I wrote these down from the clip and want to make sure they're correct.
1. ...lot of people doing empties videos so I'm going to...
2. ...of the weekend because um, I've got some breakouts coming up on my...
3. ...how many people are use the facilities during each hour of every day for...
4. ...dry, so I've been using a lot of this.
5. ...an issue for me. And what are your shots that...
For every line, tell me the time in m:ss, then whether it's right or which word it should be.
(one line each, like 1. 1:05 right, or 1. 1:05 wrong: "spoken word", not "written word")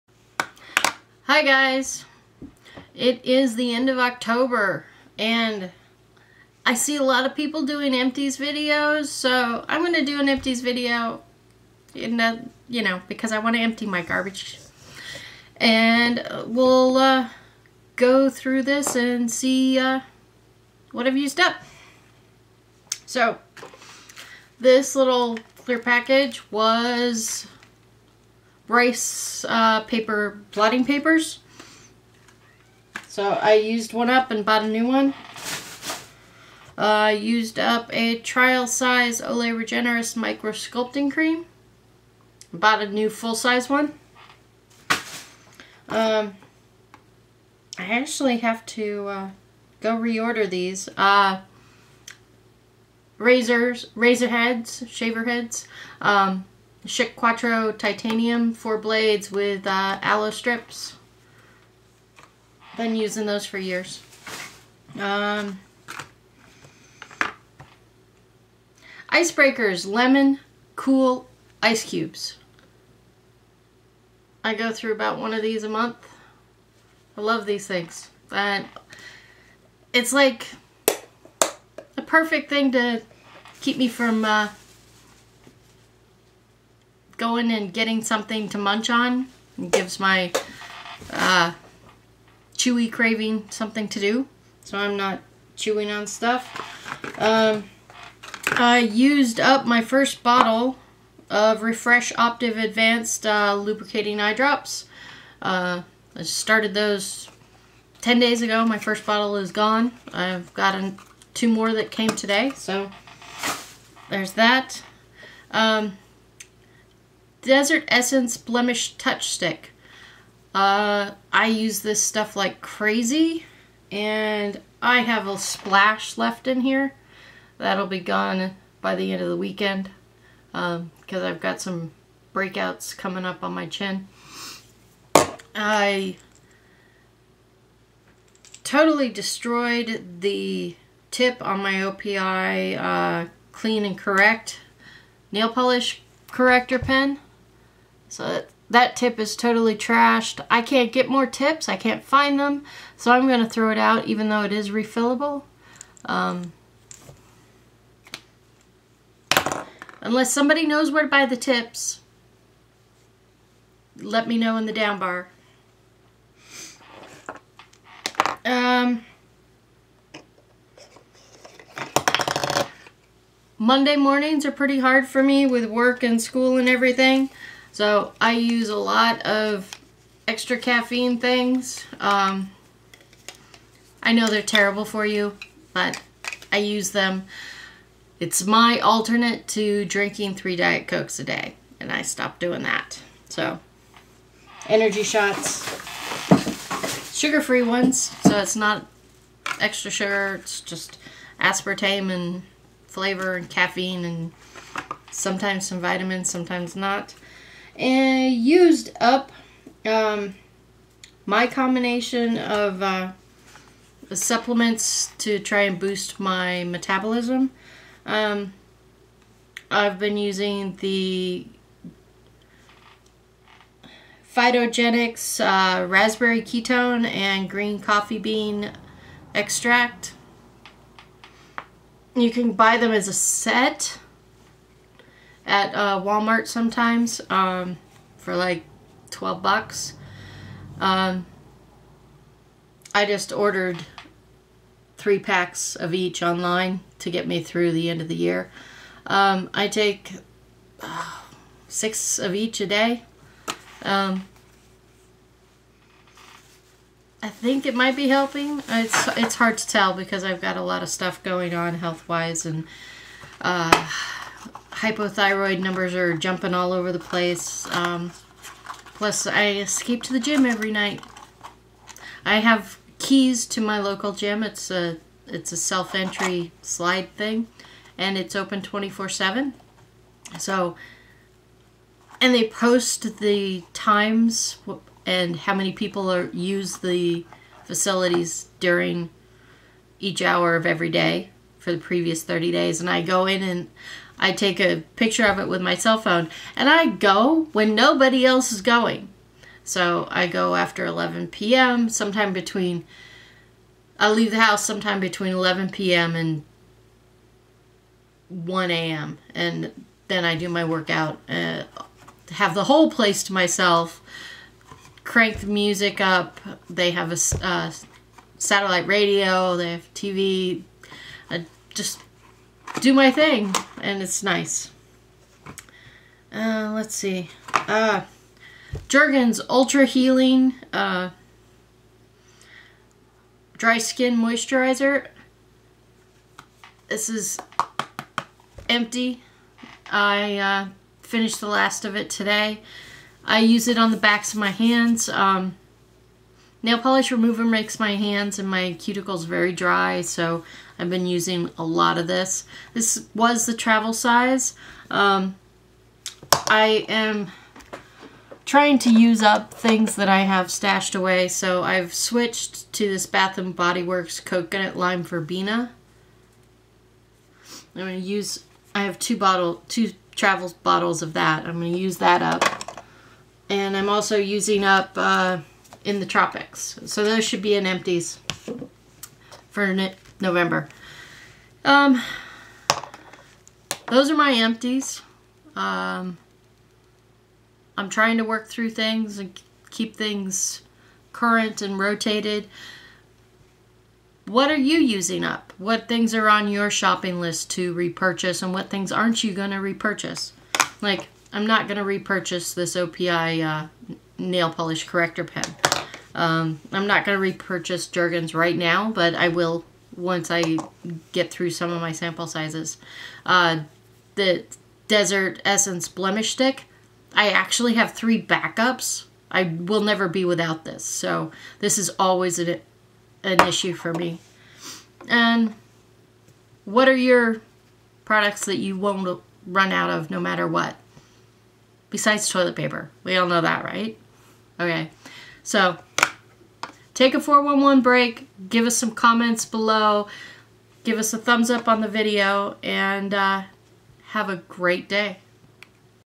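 1. 0:07 right
2. 2:09 right
3. 4:45 right
4. 5:49 right
5. 7:03 wrong: "products", not "shots".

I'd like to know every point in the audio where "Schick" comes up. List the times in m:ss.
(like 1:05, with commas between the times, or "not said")
0:56.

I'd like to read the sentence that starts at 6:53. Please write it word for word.
Uh, the Desert Essence Blemish Stick, I actually have three backups.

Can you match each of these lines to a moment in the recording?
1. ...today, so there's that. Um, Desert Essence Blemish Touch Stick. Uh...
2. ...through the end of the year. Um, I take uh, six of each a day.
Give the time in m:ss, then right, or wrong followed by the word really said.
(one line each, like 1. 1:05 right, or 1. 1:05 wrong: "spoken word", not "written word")
1. 1:52 right
2. 4:07 right.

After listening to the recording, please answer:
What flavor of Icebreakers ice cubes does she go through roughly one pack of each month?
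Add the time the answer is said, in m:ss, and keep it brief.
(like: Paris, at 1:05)
Lemon, at 1:09.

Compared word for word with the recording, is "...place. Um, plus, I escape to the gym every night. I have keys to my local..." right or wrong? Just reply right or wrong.
right.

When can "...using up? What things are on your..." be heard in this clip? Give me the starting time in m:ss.
6:34.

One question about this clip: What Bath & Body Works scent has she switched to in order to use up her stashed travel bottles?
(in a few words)
Coconut Lime Verbena.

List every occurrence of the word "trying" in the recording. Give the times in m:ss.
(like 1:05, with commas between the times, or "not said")
5:58, 6:27.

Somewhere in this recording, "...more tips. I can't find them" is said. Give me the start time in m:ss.
2:31.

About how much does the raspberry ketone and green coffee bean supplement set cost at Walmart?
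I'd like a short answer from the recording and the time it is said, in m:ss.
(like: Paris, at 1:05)
$12, at 3:59.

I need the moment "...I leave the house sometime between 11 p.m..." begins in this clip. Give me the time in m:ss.
5:03.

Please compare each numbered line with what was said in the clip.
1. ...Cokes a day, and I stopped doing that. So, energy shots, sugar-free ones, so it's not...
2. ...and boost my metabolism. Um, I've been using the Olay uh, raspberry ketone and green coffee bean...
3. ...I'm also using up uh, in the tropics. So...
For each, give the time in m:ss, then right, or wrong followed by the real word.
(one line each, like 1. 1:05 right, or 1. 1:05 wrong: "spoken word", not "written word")
1. 3:10 right
2. 3:35 wrong: "Phytogenix", not "Olay"
3. 6:13 right.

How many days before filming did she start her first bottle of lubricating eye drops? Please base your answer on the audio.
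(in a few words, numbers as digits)
10.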